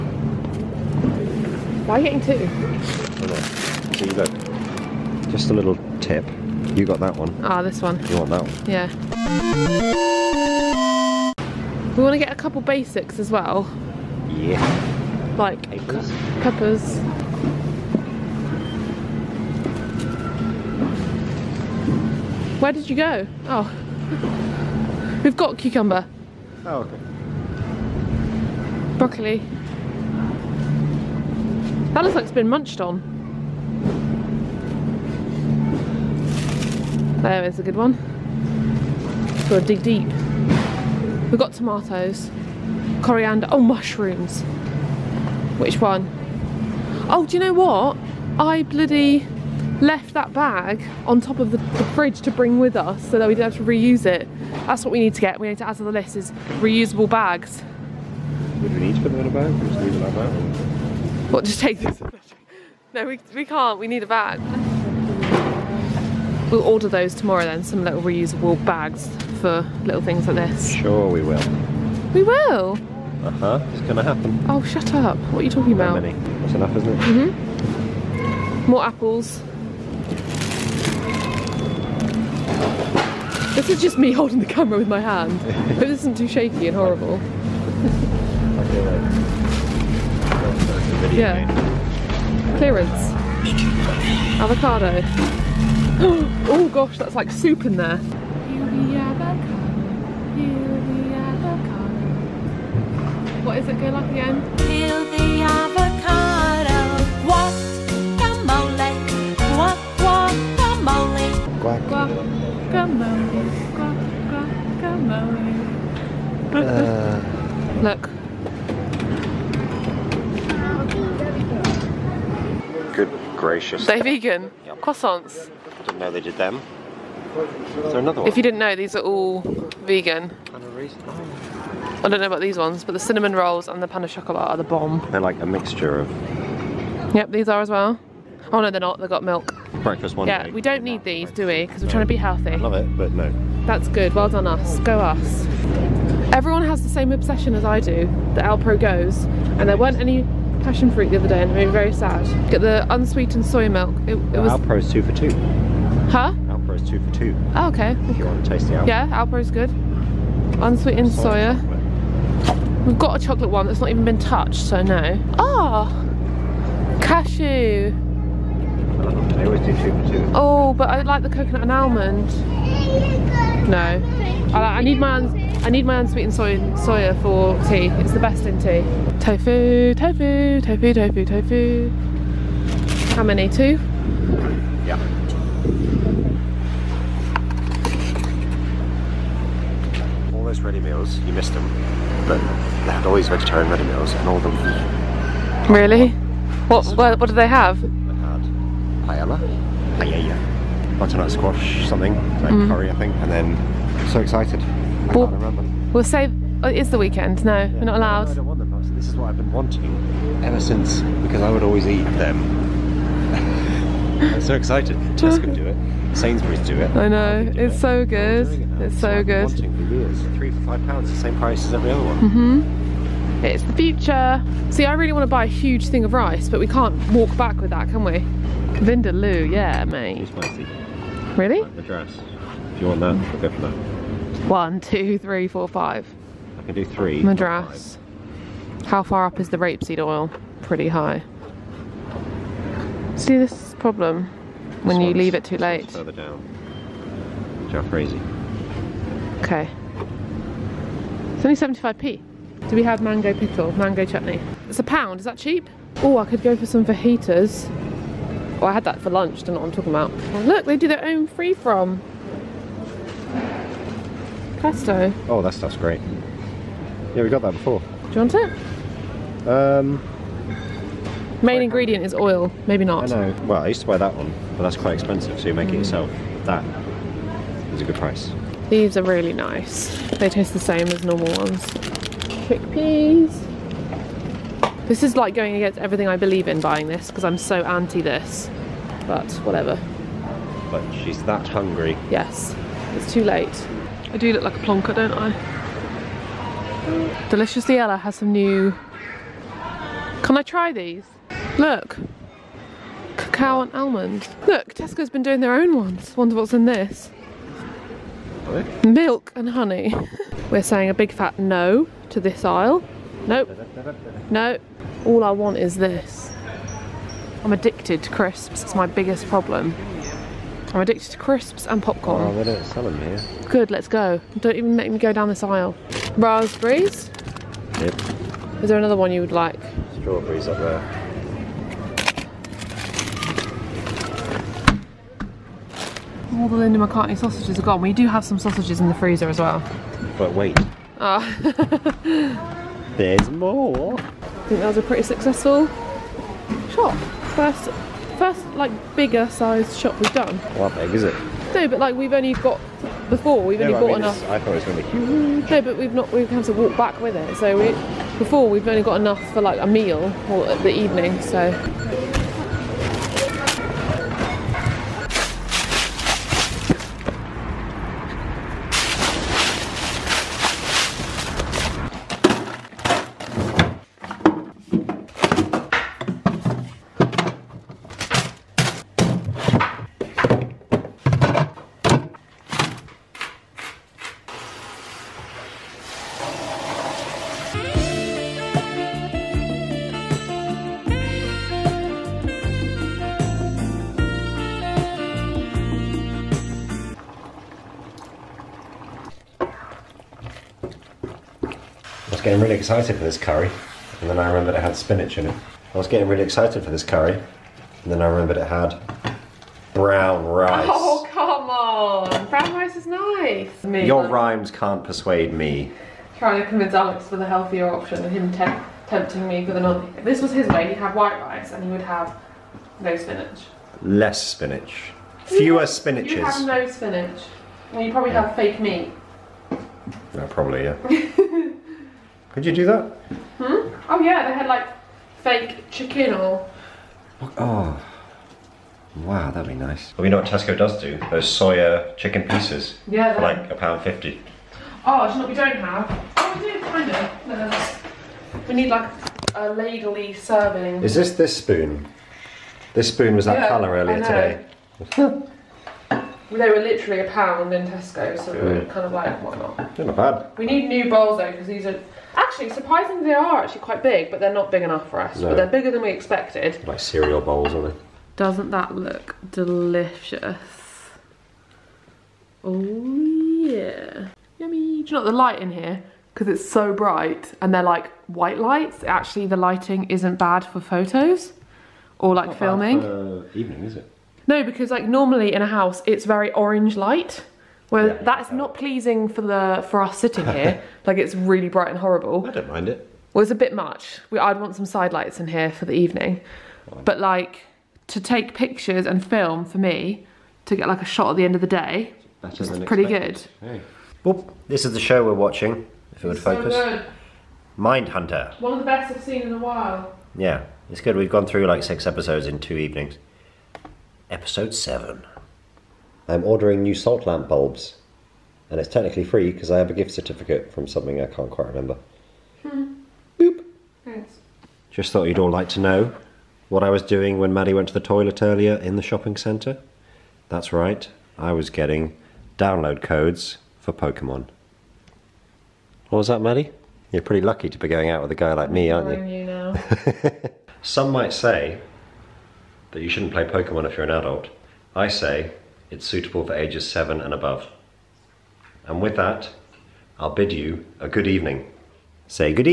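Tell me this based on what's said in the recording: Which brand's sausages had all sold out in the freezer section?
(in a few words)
Linda McCartney.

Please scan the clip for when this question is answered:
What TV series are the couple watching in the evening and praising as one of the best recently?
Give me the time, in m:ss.
8:27.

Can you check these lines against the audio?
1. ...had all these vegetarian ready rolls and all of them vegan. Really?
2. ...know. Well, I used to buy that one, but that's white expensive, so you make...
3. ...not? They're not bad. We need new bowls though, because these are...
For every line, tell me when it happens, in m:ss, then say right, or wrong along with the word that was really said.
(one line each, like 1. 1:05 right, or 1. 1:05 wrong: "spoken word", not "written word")
1. 3:12 wrong: "meals", not "rolls"
2. 4:33 wrong: "quite", not "white"
3. 7:39 right.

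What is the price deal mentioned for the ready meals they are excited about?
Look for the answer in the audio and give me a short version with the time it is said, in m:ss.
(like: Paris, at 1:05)
three for five pounds, at 3:40.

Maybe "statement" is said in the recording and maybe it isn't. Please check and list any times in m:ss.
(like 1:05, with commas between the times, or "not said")
not said.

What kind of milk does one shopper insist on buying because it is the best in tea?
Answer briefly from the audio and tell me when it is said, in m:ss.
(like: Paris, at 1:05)
unsweetened soya, at 2:40.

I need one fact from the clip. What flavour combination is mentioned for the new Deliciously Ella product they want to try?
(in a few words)
cacao and almond.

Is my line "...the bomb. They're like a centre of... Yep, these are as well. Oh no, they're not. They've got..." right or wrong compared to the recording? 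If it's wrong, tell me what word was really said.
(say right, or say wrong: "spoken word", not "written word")
wrong: "mixture", not "centre".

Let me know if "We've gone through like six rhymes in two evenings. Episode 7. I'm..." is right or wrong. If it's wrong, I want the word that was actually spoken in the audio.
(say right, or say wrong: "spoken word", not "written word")
wrong: "episodes", not "rhymes".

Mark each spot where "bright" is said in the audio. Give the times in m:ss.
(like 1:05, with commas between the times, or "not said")
7:56, 8:11.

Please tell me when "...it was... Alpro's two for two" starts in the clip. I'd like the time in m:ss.
2:34.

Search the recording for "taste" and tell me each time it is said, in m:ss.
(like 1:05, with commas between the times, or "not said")
2:38, 4:40.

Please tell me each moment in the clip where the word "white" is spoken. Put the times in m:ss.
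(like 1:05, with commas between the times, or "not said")
7:00, 7:58.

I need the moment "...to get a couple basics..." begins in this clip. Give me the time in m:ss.
0:12.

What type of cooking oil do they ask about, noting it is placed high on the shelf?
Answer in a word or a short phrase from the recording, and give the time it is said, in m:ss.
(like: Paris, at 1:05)
rapeseed oil, at 3:59.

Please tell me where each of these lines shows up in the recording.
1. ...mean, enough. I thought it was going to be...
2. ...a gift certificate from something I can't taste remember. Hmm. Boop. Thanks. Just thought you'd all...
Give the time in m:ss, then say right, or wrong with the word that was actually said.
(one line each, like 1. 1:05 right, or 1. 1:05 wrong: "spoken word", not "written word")
1. 5:53 right
2. 8:39 wrong: "quite", not "taste".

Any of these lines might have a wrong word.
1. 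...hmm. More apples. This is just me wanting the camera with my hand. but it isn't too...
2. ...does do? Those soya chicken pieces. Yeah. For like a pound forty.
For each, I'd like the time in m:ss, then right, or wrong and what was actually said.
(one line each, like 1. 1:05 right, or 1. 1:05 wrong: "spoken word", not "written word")
1. 1:17 wrong: "holding", not "wanting"
2. 7:20 wrong: "fifty", not "forty".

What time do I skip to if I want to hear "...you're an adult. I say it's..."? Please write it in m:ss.
9:03.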